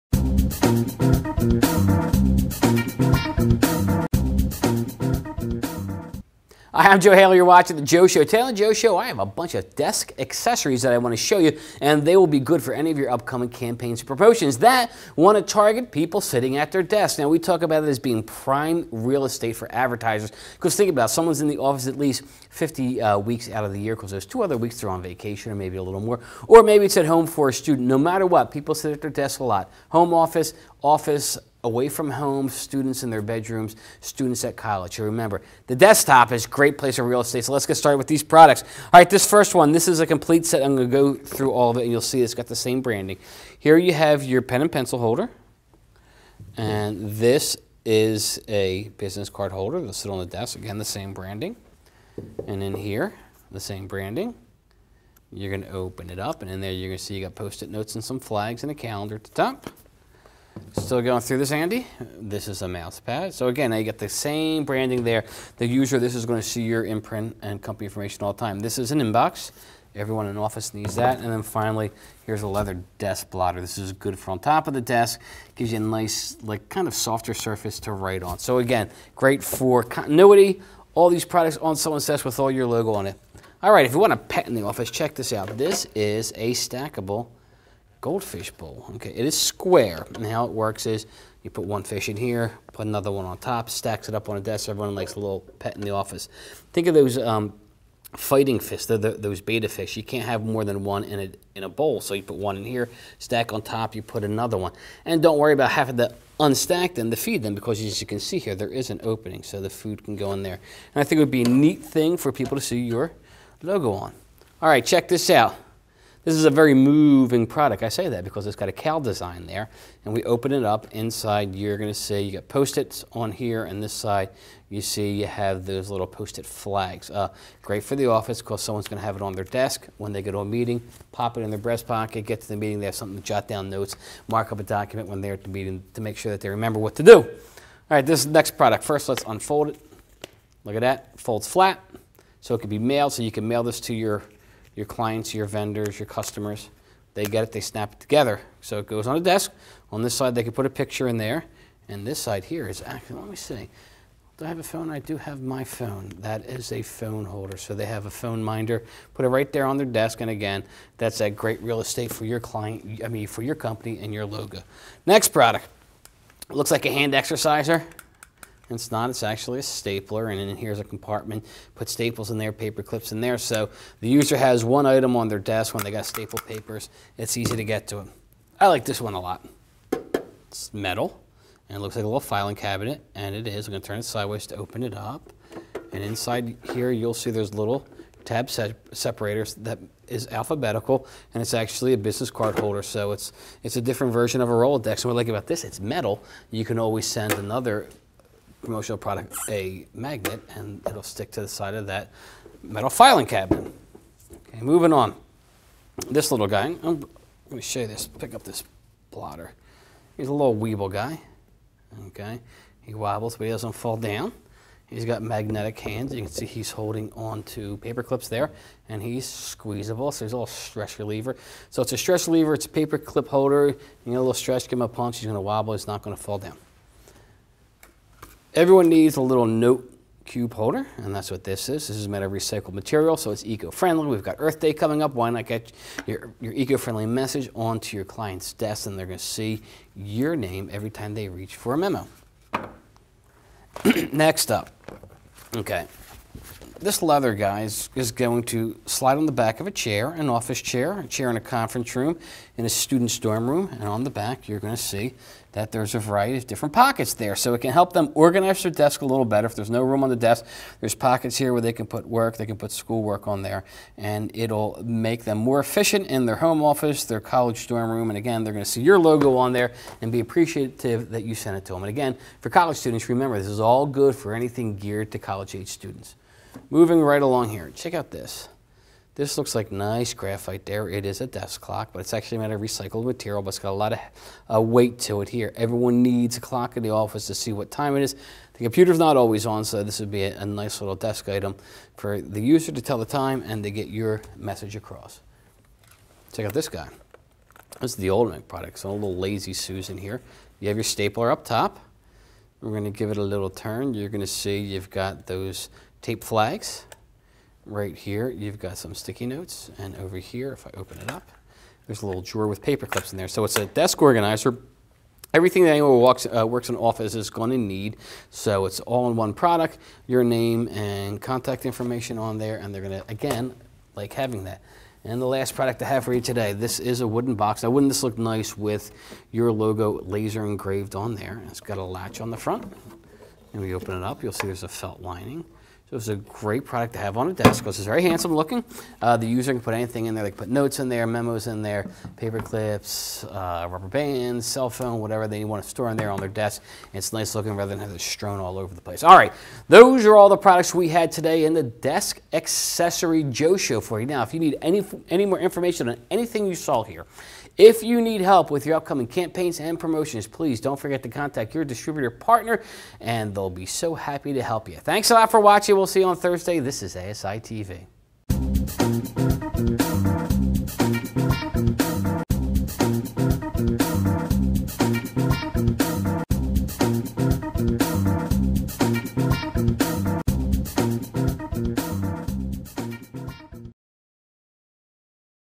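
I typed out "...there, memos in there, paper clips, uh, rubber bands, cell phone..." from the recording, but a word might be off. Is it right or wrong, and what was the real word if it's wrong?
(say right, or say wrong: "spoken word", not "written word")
right.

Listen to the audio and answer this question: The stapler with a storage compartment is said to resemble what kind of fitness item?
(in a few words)
Hand exerciser.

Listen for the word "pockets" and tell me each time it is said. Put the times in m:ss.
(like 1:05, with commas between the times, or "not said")
2:11, 4:16, 4:20.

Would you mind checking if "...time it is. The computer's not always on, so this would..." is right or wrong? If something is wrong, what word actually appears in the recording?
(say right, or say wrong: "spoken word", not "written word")
right.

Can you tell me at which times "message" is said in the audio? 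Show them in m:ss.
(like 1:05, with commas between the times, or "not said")
3:57, 4:54.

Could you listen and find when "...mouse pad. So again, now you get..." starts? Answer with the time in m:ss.
1:02.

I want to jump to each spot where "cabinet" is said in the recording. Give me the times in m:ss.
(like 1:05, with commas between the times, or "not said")
3:02, 3:23.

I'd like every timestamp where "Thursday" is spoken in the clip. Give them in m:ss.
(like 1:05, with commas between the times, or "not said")
6:06.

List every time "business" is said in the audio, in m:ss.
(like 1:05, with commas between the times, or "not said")
0:48, 3:11.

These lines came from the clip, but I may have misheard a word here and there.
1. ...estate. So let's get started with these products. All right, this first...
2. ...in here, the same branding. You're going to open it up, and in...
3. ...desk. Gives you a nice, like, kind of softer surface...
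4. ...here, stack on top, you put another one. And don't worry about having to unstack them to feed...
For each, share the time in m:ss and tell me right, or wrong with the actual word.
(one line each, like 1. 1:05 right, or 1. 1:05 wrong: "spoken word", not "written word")
1. 0:37 right
2. 0:52 right
3. 1:14 right
4. 1:42 right.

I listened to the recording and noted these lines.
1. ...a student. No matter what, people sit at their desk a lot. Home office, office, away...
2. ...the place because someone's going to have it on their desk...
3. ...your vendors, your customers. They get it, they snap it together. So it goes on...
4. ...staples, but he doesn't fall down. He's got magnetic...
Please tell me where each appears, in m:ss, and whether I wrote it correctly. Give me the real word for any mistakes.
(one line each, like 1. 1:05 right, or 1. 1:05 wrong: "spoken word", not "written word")
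1. 0:27 right
2. 2:07 wrong: "office", not "place"
3. 2:25 right
4. 3:32 wrong: "wobbles", not "staples".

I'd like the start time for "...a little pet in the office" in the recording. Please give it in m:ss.
1:35.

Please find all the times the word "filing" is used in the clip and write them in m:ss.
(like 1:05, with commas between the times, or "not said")
3:02, 3:22.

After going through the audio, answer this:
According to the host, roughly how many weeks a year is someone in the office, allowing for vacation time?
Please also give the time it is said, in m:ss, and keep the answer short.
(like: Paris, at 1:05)
50, at 0:22.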